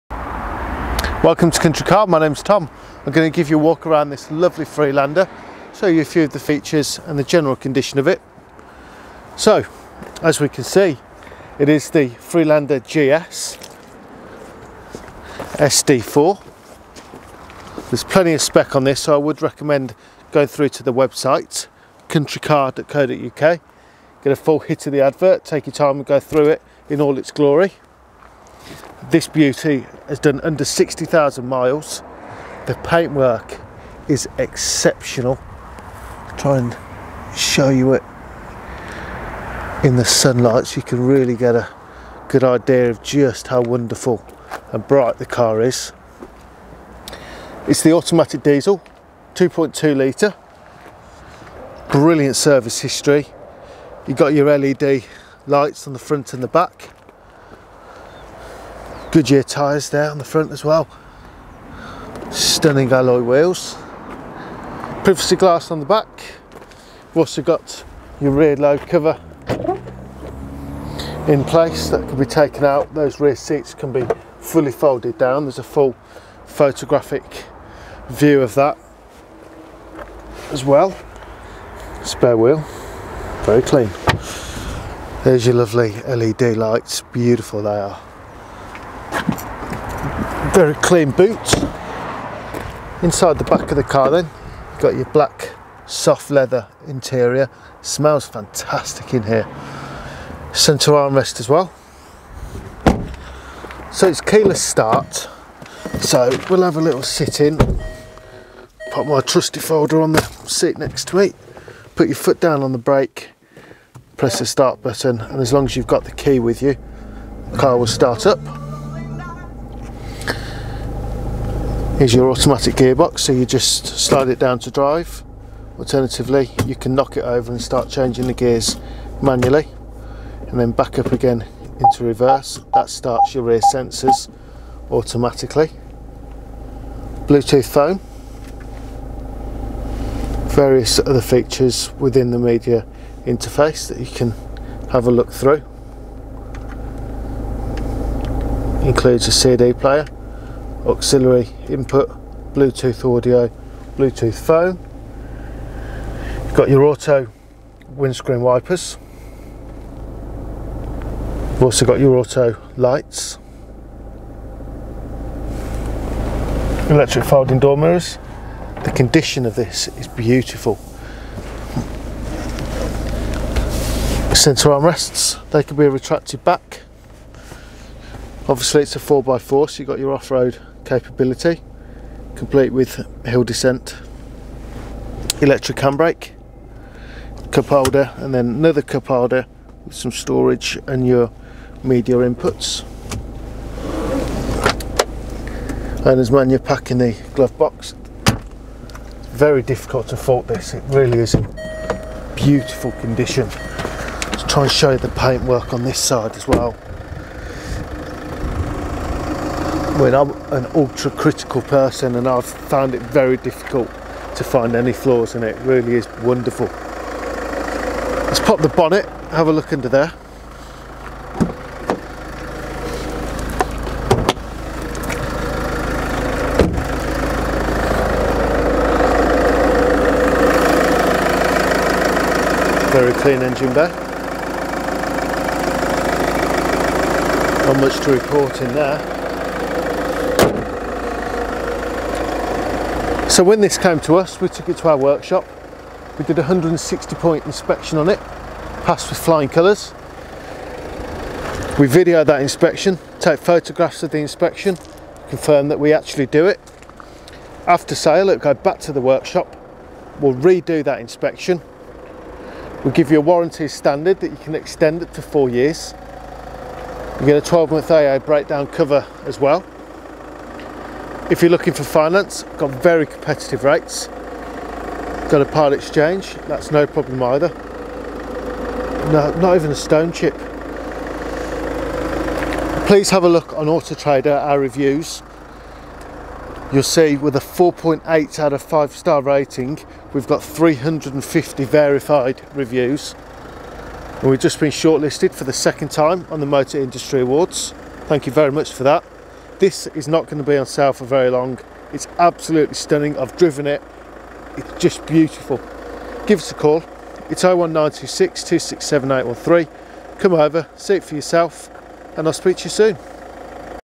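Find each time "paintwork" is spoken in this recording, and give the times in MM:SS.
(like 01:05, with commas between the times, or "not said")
00:32, 03:25.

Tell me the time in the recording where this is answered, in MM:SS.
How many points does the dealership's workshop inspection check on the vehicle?
04:06.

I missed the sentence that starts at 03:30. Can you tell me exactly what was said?
I mean, I'm an ultra critical person and I've found it very difficult to find any flaws in it.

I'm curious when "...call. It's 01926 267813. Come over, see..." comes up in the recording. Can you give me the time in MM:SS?
05:06.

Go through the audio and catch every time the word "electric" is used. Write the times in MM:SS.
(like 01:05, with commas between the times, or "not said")
02:46, 03:05.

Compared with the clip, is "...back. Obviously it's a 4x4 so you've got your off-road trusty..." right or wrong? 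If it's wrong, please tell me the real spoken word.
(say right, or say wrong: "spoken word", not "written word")
wrong: "capability", not "trusty".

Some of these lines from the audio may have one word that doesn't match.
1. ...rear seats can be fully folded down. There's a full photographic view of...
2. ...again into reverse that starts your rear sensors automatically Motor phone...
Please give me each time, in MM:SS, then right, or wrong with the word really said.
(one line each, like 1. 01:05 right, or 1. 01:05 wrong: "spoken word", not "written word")
1. 01:13 right
2. 02:11 wrong: "Bluetooth", not "Motor".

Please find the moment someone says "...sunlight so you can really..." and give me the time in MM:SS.
00:40.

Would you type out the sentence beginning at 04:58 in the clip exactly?
Thank you very much for that.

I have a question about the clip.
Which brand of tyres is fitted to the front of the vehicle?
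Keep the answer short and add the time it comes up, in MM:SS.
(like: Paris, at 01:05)
Goodyear, at 00:59.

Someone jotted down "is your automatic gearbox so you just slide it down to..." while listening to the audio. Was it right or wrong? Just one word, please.
right.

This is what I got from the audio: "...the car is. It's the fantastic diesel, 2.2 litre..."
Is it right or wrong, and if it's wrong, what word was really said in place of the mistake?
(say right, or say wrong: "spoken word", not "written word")
wrong: "automatic", not "fantastic".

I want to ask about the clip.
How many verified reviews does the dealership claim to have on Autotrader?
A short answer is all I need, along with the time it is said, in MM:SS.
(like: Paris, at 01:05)
350, at 04:50.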